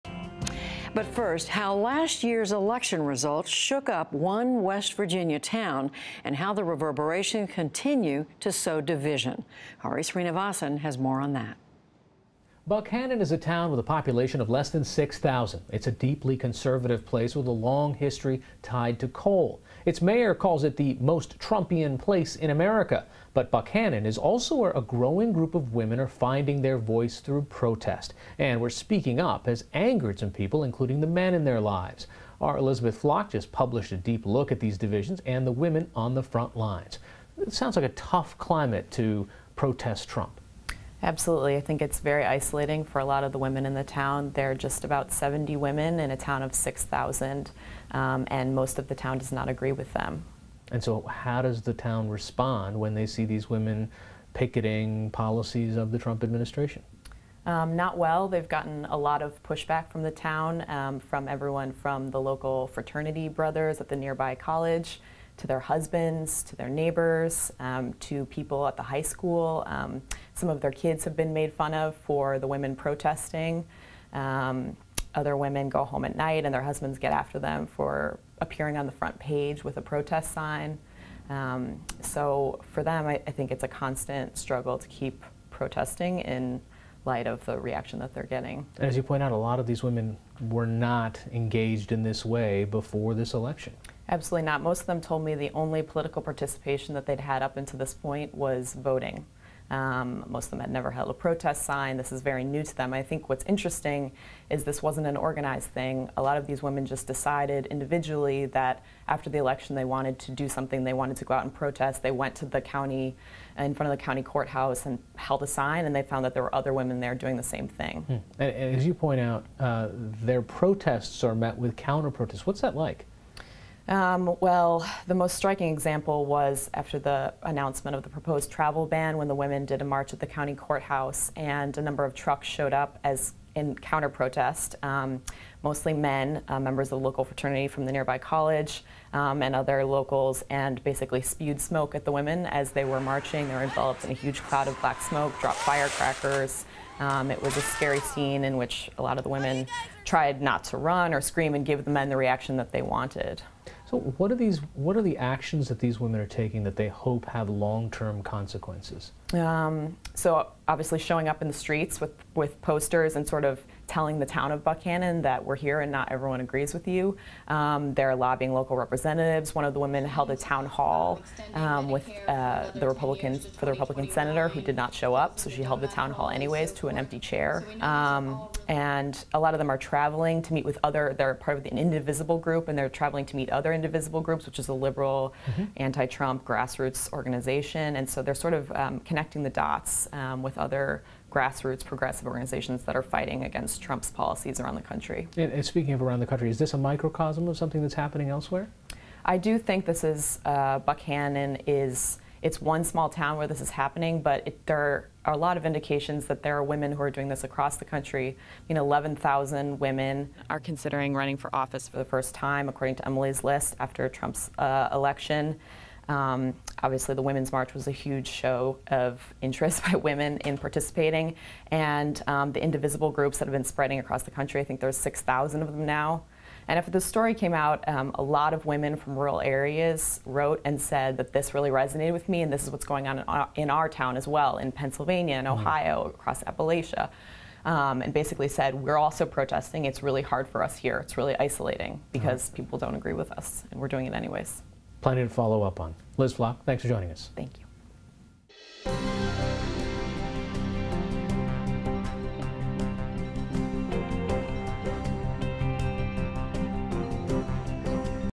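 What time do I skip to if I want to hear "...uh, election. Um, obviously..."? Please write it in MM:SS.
03:34.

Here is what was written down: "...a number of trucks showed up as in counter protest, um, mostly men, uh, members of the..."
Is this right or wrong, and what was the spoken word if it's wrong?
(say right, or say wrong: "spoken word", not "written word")
right.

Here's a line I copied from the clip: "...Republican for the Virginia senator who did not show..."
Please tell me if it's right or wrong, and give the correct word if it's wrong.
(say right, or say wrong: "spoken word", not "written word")
wrong: "Republican", not "Virginia".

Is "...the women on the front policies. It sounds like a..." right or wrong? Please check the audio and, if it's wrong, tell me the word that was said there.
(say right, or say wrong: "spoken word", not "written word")
wrong: "lines", not "policies".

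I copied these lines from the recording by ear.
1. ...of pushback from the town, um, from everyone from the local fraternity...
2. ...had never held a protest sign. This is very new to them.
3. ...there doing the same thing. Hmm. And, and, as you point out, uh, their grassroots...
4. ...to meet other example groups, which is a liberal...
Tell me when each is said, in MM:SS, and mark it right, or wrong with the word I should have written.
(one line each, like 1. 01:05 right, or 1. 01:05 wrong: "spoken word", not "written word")
1. 00:59 right
2. 01:40 right
3. 01:56 wrong: "protests", not "grassroots"
4. 03:03 wrong: "indivisible", not "example".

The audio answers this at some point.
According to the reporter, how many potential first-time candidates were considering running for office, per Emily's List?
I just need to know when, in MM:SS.
03:28.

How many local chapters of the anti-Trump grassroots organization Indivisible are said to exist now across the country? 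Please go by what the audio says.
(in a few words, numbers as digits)
6,000.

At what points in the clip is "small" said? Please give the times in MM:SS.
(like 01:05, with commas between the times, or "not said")
03:22.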